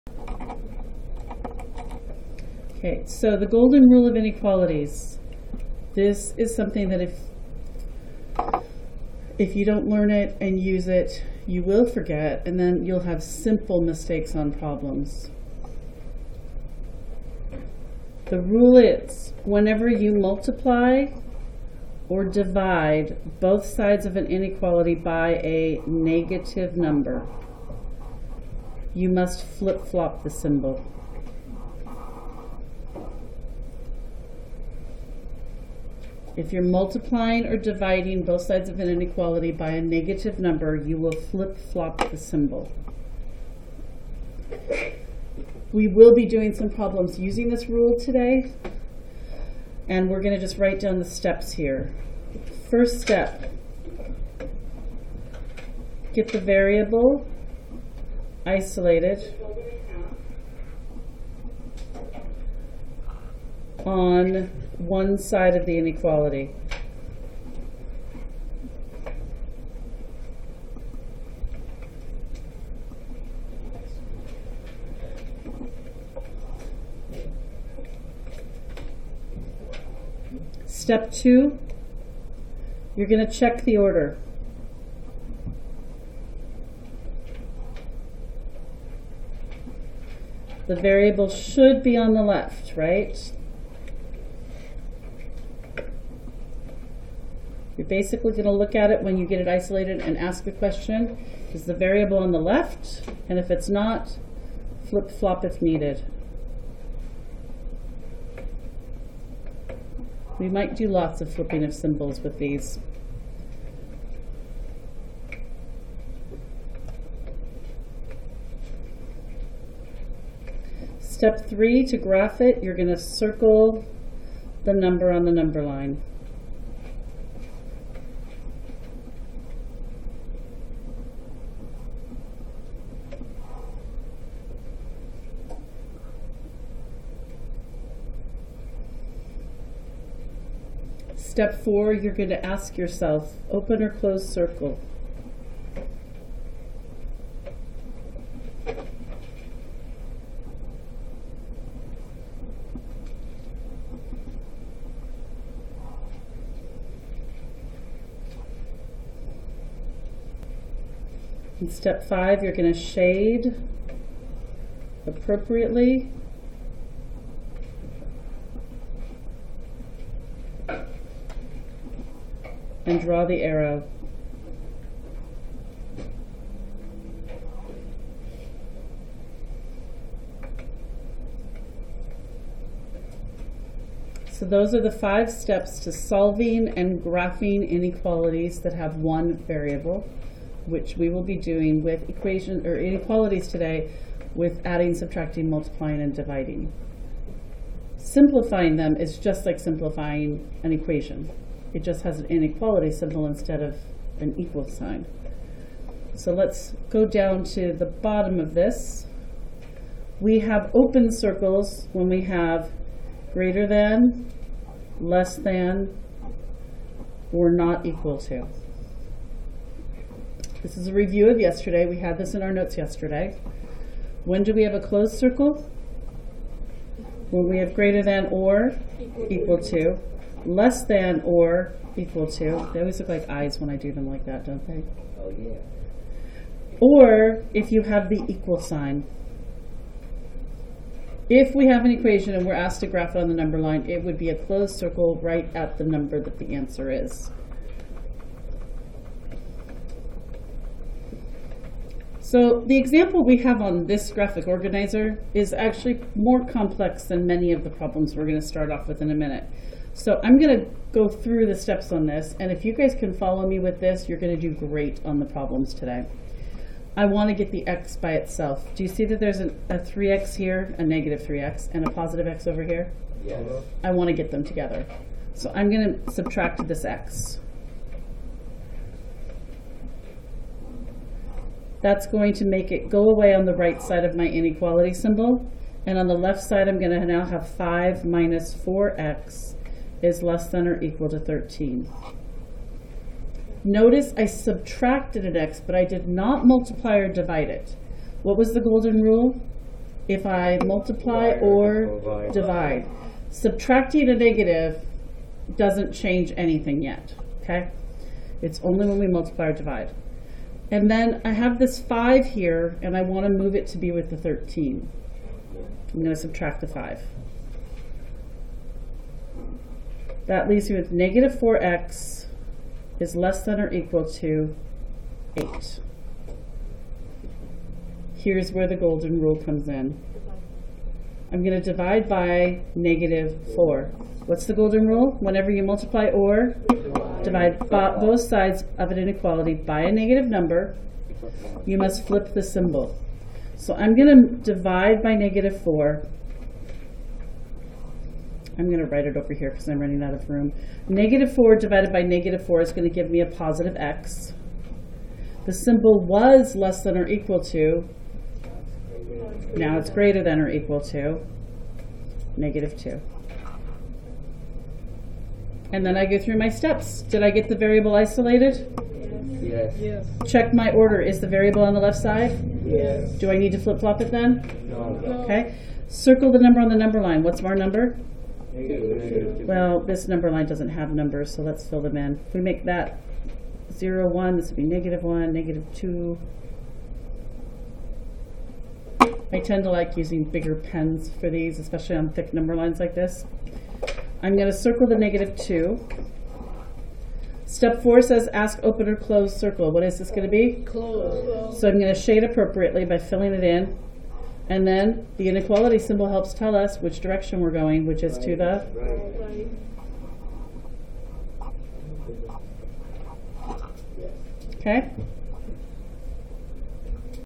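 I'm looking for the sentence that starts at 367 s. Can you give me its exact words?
Did I get the variable isolated?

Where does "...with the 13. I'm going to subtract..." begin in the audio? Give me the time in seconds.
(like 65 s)
313 s.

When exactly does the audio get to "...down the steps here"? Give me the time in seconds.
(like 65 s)
50 s.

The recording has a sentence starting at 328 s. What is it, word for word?
Here's where the golden rule comes in.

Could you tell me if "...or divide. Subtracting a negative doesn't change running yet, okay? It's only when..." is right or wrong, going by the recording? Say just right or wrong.
wrong.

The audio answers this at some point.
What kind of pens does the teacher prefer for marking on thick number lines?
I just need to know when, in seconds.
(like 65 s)
390 s.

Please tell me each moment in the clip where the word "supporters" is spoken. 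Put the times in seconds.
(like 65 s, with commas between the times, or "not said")
not said.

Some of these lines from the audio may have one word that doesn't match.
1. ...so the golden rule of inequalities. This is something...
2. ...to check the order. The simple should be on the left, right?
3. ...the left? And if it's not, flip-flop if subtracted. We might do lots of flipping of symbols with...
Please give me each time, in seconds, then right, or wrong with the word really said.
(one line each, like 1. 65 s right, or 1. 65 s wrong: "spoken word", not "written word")
1. 3 s right
2. 83 s wrong: "variable", not "simple"
3. 102 s wrong: "needed", not "subtracted".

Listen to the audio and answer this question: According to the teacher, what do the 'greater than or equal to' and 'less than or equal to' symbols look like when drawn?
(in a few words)
eyes.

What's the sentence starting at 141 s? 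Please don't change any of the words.
Step four, you're going to ask yourself open or closed circle.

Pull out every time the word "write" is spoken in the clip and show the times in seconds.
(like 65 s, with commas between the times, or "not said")
50 s, 348 s.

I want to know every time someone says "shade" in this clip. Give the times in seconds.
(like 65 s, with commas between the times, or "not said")
162 s, 401 s.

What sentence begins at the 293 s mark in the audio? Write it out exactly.
Notice I subtracted an x, but I did not multiply or divide it.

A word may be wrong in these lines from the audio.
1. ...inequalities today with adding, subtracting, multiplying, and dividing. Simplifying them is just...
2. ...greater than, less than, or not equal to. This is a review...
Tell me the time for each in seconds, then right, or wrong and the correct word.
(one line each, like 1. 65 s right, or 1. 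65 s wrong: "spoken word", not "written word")
1. 192 s right
2. 213 s right.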